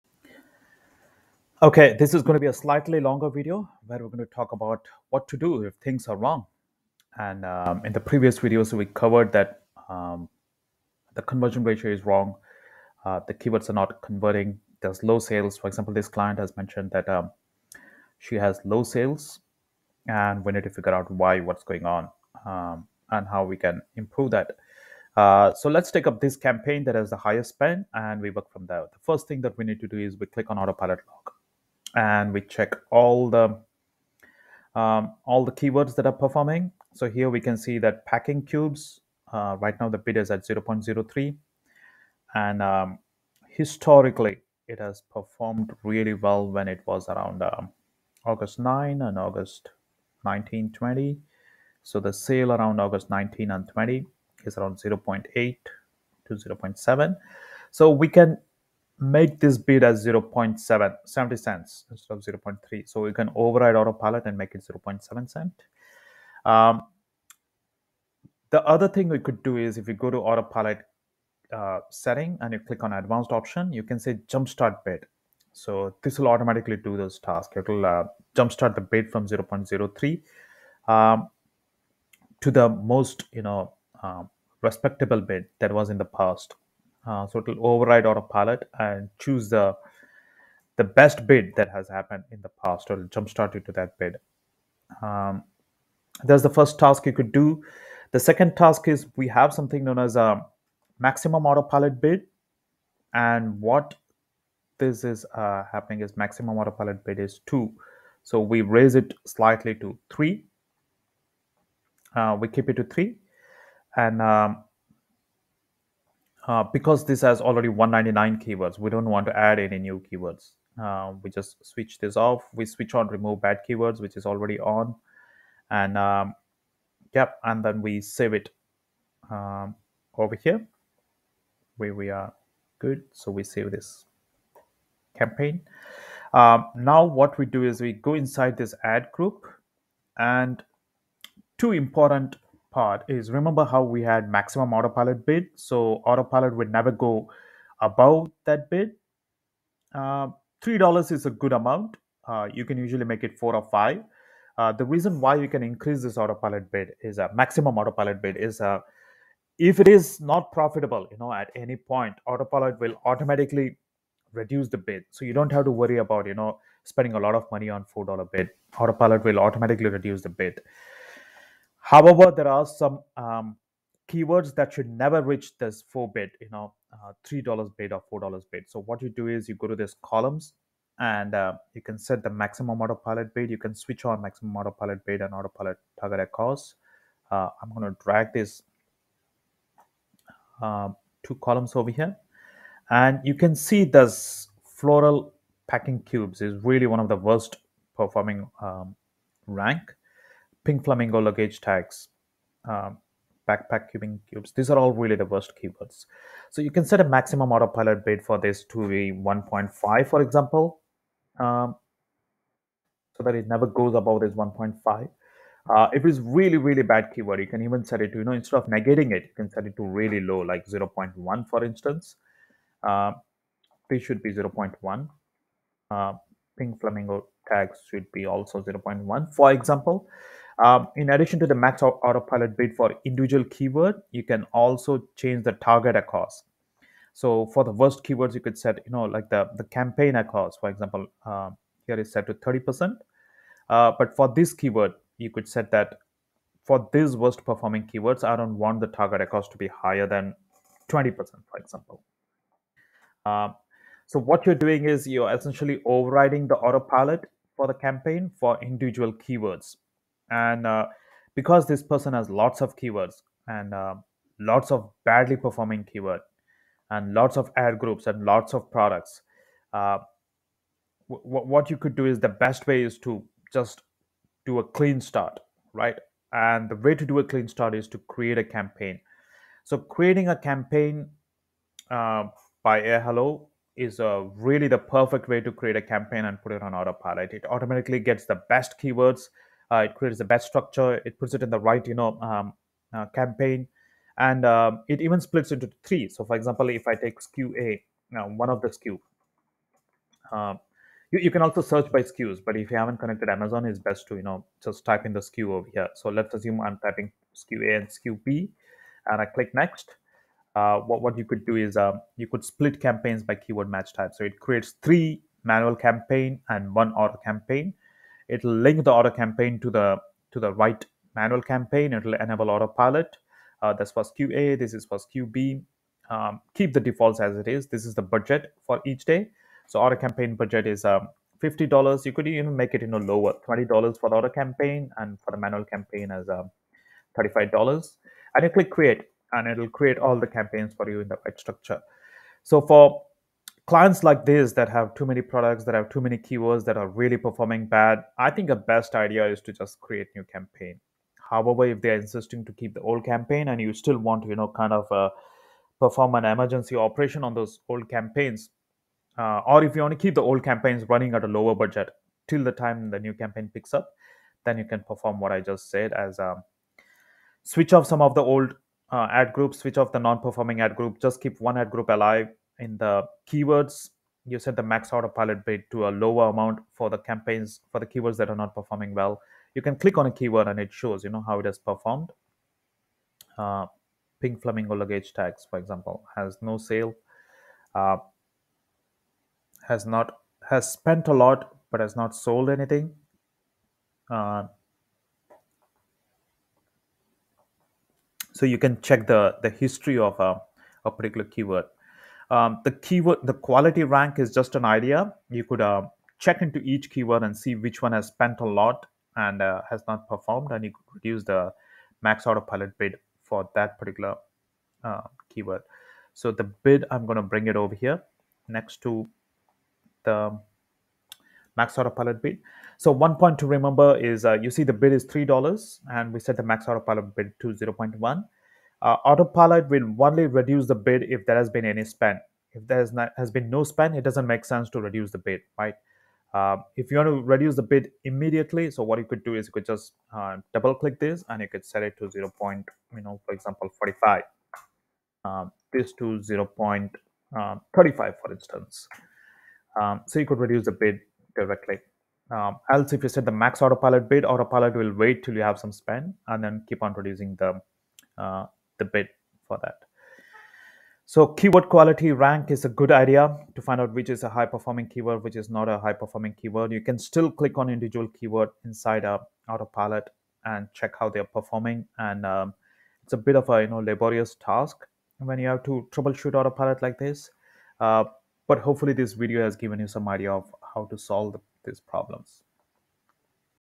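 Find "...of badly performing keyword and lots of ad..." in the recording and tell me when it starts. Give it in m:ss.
4:24.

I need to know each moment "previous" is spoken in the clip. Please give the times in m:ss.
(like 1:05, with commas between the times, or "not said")
0:07.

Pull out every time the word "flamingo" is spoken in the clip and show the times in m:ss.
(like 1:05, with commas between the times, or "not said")
3:20, 3:46, 6:24.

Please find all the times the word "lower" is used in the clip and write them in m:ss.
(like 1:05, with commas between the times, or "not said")
5:33, 6:01, 6:15.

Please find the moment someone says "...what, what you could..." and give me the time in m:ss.
5:10.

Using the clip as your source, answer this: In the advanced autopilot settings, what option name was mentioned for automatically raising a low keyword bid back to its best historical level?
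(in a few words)
jumpstart bid.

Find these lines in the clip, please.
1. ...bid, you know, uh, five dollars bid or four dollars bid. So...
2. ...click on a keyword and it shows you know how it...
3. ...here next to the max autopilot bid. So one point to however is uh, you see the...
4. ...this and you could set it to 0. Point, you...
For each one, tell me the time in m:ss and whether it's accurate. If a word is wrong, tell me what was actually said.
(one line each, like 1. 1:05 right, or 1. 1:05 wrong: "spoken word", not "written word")
1. 2:56 wrong: "three", not "five"
2. 6:19 right
3. 6:57 wrong: "remember", not "however"
4. 7:20 right.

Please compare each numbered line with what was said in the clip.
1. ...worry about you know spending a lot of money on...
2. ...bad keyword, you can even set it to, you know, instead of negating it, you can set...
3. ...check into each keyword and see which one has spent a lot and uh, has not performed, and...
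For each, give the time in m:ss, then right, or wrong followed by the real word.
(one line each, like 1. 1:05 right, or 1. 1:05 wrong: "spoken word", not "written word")
1. 2:45 right
2. 3:36 right
3. 6:46 right.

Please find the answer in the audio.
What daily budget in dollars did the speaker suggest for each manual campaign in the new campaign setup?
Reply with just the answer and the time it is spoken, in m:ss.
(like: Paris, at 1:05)
35, at 5:37.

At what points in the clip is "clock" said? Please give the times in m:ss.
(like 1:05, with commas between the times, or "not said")
not said.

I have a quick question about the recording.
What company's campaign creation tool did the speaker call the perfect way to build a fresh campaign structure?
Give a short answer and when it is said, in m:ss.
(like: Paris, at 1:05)
AiHello, at 4:42.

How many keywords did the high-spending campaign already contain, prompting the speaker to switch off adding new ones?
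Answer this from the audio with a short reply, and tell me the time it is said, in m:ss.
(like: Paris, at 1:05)
199, at 1:57.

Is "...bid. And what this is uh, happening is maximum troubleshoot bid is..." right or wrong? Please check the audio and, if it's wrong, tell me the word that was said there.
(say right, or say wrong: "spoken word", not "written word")
wrong: "autopilot", not "troubleshoot".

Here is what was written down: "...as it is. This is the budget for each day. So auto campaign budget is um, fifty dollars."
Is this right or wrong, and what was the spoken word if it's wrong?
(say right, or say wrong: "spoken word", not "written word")
right.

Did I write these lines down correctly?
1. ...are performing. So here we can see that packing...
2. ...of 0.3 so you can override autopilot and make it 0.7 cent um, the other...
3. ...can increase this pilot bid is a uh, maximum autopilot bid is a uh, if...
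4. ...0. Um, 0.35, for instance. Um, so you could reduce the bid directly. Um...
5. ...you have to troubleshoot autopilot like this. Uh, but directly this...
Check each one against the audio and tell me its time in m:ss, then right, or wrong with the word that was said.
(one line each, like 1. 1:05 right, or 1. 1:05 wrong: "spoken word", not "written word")
1. 0:36 right
2. 1:02 right
3. 2:35 wrong: "autopilot", not "pilot"
4. 7:26 right
5. 7:55 wrong: "hopefully", not "directly".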